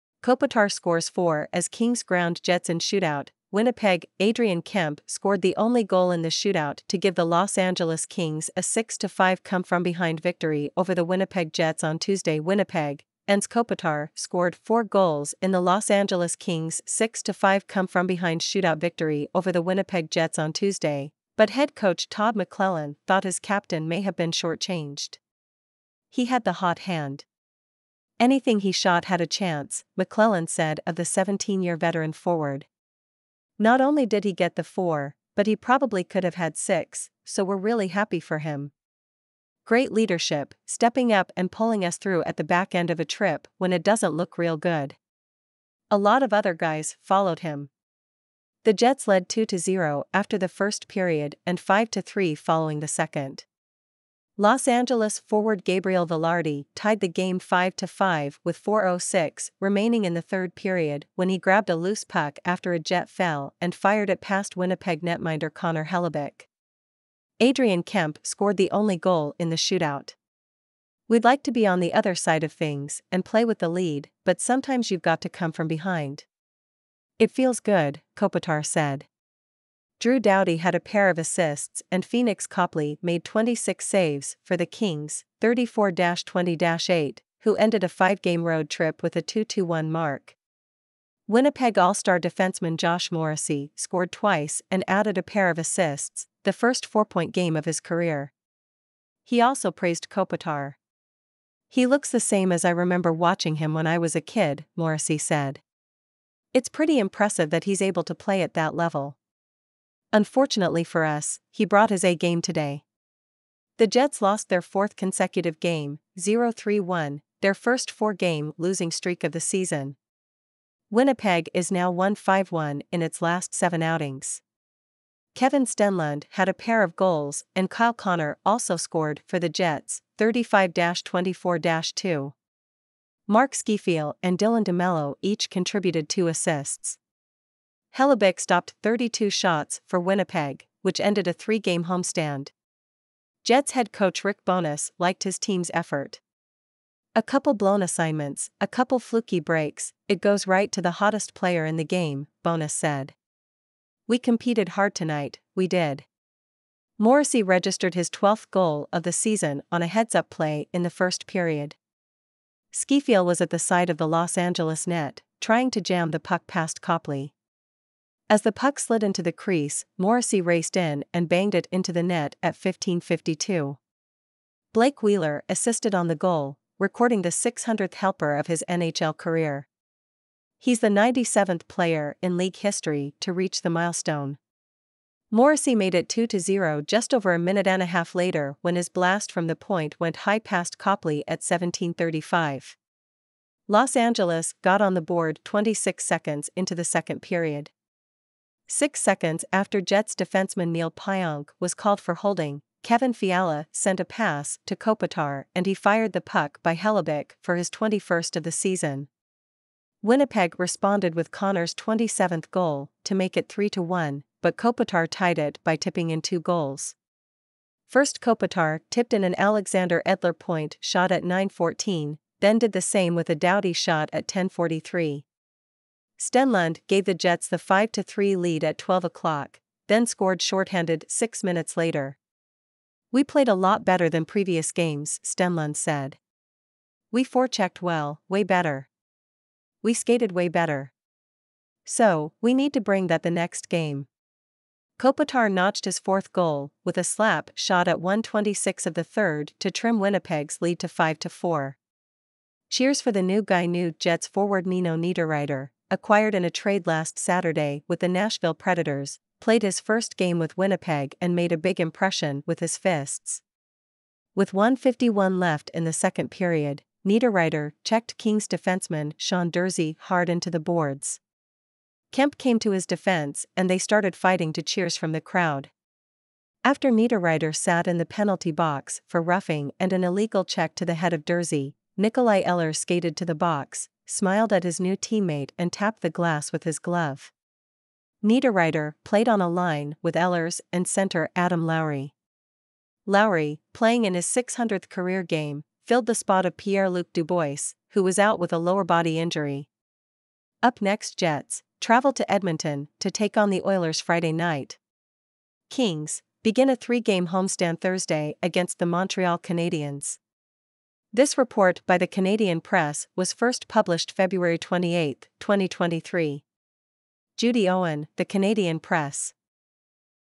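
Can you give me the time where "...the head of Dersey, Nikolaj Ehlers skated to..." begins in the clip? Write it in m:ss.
4:40.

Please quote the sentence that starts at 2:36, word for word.
Morrissey registered his 12th goal of the season on a heads up play in the first period.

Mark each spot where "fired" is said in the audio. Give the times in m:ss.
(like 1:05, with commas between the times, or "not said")
1:03, 3:25.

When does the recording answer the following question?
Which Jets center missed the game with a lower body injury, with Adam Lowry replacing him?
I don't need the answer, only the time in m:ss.
4:56.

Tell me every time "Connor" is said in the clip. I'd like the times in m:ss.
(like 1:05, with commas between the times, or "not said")
1:05, 2:07, 3:31.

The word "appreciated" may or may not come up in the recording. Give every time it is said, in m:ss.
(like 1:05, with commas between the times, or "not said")
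not said.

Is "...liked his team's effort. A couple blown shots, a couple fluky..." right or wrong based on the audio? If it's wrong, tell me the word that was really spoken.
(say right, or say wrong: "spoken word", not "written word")
wrong: "assignments", not "shots".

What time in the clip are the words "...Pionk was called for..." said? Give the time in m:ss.
3:20.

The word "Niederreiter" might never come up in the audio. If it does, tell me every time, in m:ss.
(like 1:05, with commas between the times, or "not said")
4:14, 4:27, 4:36, 4:48.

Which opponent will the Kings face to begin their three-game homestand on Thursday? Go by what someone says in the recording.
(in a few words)
Montreal Canadiens.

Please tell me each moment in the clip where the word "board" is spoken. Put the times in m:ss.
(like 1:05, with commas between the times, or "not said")
3:15, 4:30.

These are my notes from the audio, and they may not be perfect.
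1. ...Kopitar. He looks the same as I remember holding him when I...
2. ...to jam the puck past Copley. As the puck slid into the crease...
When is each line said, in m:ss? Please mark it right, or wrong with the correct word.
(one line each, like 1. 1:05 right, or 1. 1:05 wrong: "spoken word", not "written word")
1. 1:40 wrong: "watching", not "holding"
2. 2:45 right.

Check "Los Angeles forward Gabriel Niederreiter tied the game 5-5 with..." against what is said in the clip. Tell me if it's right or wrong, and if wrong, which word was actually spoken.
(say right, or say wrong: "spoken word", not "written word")
wrong: "Vilardi", not "Niederreiter".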